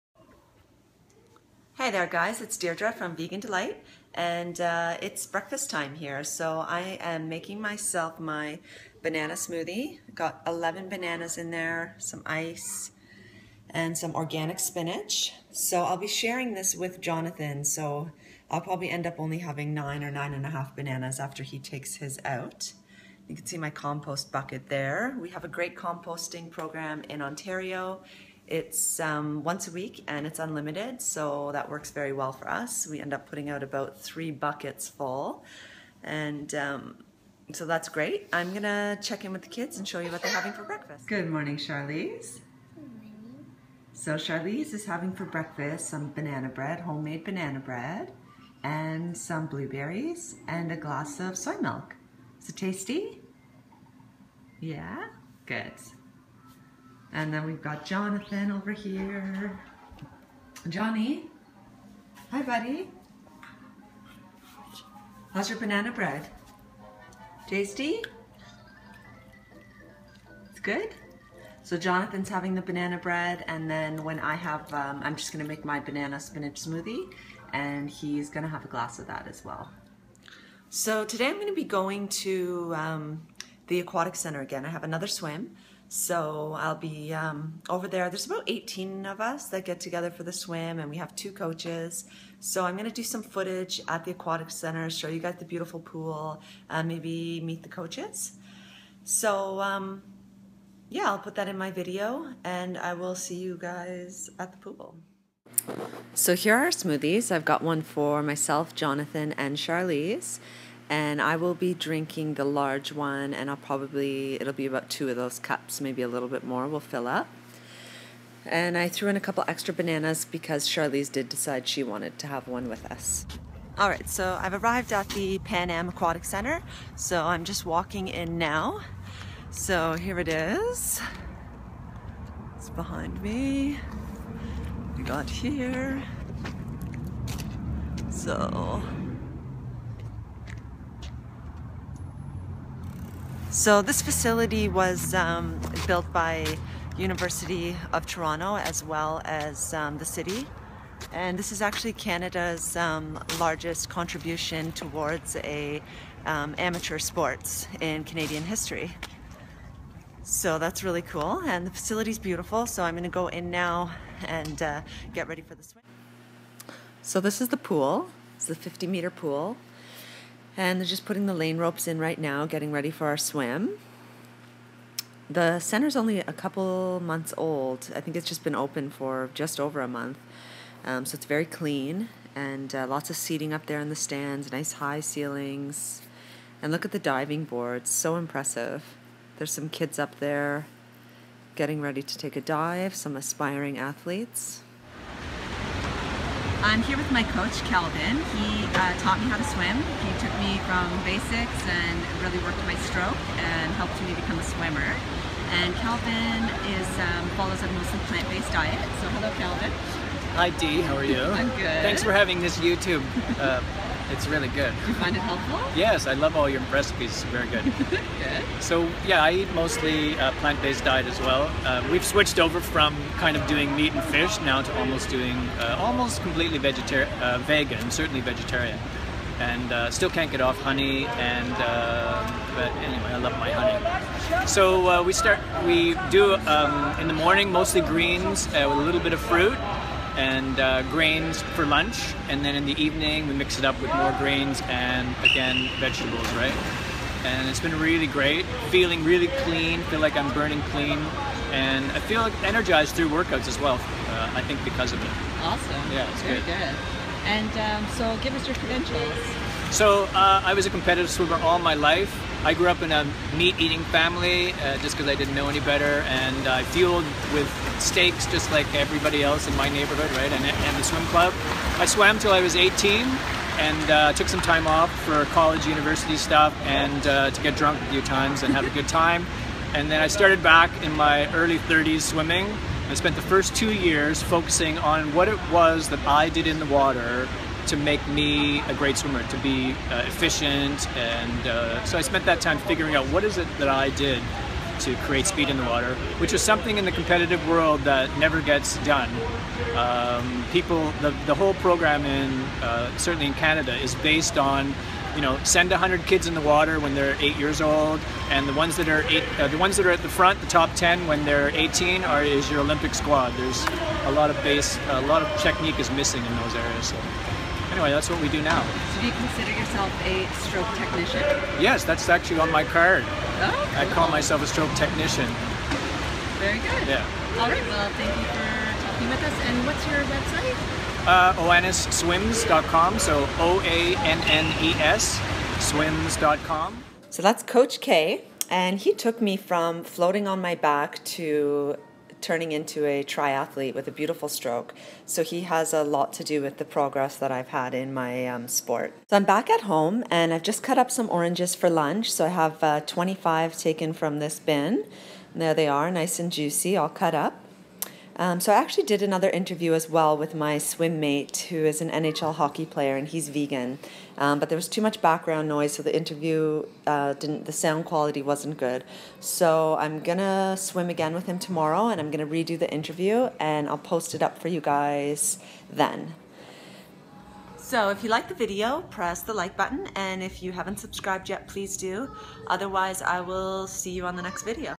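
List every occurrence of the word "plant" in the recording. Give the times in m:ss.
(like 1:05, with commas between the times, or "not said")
3:28, 3:40.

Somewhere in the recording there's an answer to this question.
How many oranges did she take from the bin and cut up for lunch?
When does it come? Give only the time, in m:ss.
5:52.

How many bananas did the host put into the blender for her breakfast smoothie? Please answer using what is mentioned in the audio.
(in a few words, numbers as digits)
11.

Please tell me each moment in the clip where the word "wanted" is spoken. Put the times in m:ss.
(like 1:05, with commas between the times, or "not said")
2:01.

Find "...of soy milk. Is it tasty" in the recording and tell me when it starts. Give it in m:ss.
0:51.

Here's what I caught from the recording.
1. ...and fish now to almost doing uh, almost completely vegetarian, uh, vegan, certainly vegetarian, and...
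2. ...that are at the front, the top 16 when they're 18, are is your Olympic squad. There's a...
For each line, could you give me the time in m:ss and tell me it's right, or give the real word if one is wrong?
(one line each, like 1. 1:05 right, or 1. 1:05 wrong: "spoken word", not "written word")
1. 3:43 right
2. 5:09 wrong: "10", not "16".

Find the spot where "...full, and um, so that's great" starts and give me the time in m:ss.
0:34.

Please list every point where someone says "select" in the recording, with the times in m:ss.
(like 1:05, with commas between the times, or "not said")
not said.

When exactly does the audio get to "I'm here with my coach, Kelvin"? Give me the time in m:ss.
3:16.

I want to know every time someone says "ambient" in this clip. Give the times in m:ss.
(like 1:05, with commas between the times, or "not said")
not said.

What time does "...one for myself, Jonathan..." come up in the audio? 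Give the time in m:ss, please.
1:47.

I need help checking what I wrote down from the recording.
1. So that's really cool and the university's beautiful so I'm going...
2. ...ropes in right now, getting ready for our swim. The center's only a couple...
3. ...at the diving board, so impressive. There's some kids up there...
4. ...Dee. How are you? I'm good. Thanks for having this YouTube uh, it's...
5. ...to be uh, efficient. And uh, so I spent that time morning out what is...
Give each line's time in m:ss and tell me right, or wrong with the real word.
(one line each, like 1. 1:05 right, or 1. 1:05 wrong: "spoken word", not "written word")
1. 2:40 wrong: "facility", not "university"
2. 2:51 right
3. 3:06 right
4. 3:30 right
5. 4:49 wrong: "figuring", not "morning".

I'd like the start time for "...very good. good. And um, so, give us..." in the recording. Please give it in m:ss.
4:16.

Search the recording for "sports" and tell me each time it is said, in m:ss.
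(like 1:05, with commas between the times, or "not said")
2:36, 5:48.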